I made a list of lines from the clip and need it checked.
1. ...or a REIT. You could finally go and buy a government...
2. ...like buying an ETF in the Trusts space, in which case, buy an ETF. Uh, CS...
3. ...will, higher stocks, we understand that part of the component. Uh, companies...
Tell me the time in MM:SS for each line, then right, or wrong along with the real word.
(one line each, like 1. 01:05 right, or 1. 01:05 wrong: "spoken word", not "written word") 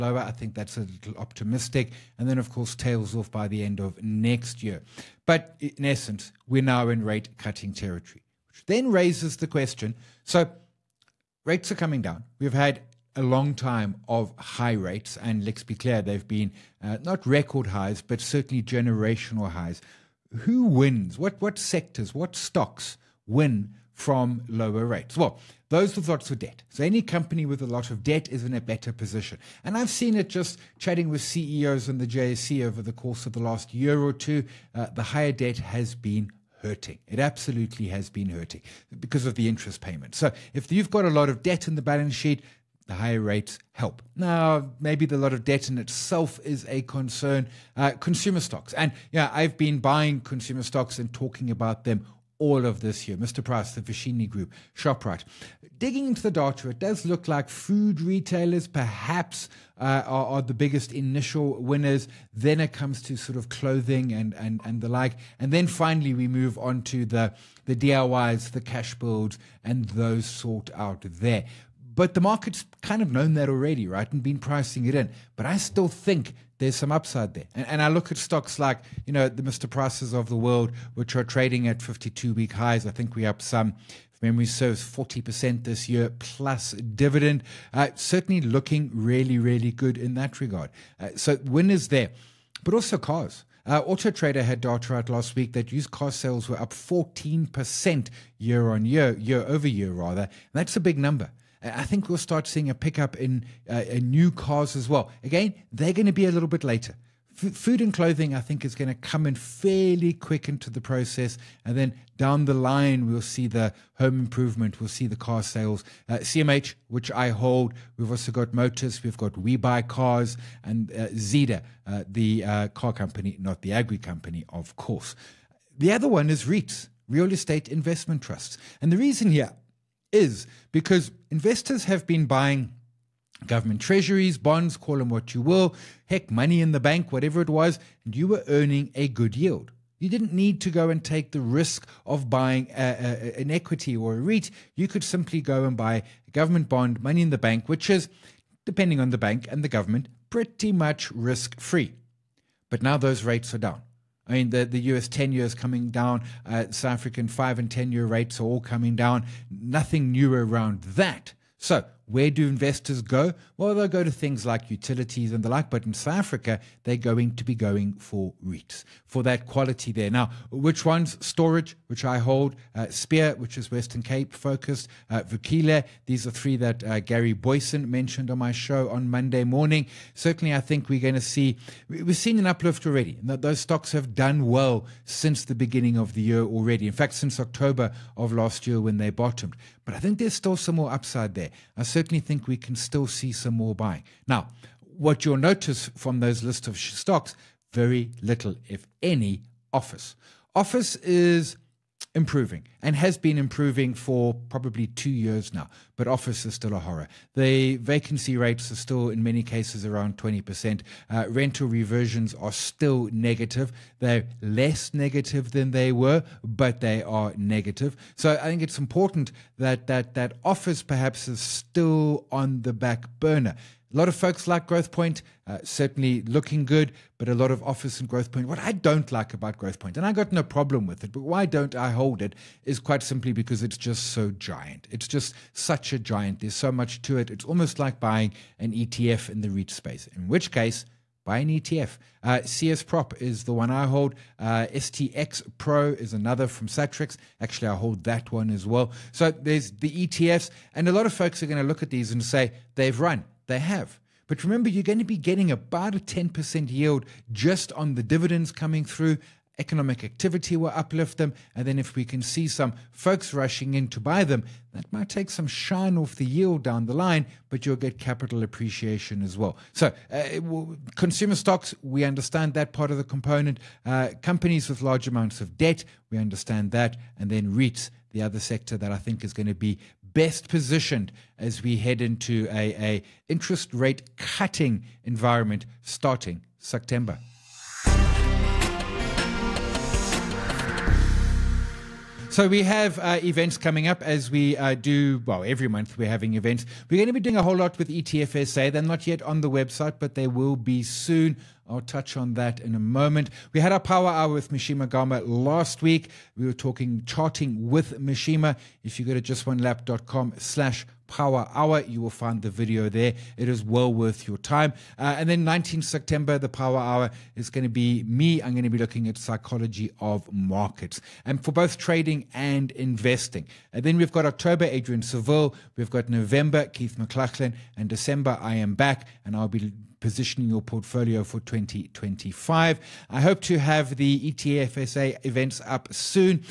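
1. 02:23 wrong: "simply", not "finally"
2. 03:57 wrong: "REIT", not "Trusts"
3. 04:30 wrong: "consumer", not "higher".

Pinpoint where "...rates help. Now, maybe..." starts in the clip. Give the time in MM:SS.
00:43.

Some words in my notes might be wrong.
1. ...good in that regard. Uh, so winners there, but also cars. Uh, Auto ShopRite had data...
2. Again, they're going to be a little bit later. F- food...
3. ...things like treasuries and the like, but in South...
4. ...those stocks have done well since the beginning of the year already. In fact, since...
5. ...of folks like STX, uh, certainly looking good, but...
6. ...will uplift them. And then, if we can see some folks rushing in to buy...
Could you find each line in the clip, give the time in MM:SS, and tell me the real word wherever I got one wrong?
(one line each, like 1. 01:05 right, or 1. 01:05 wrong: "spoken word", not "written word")
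1. 01:29 wrong: "Trader", not "ShopRite"
2. 01:45 right
3. 02:44 wrong: "utilities", not "treasuries"
4. 03:03 right
5. 03:44 wrong: "Growthpoint", not "STX"
6. 04:20 right.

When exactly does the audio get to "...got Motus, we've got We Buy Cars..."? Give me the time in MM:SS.
01:58.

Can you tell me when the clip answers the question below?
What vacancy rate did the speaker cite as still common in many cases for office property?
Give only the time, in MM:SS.
03:30.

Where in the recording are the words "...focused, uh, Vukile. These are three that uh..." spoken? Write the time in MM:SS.
02:54.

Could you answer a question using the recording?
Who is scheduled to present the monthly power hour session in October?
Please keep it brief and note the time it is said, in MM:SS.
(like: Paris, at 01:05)
Adrian Saville, at 05:24.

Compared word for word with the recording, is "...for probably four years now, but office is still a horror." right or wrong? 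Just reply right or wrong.
wrong.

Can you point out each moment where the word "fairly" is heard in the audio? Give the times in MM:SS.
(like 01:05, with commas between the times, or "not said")
01:49.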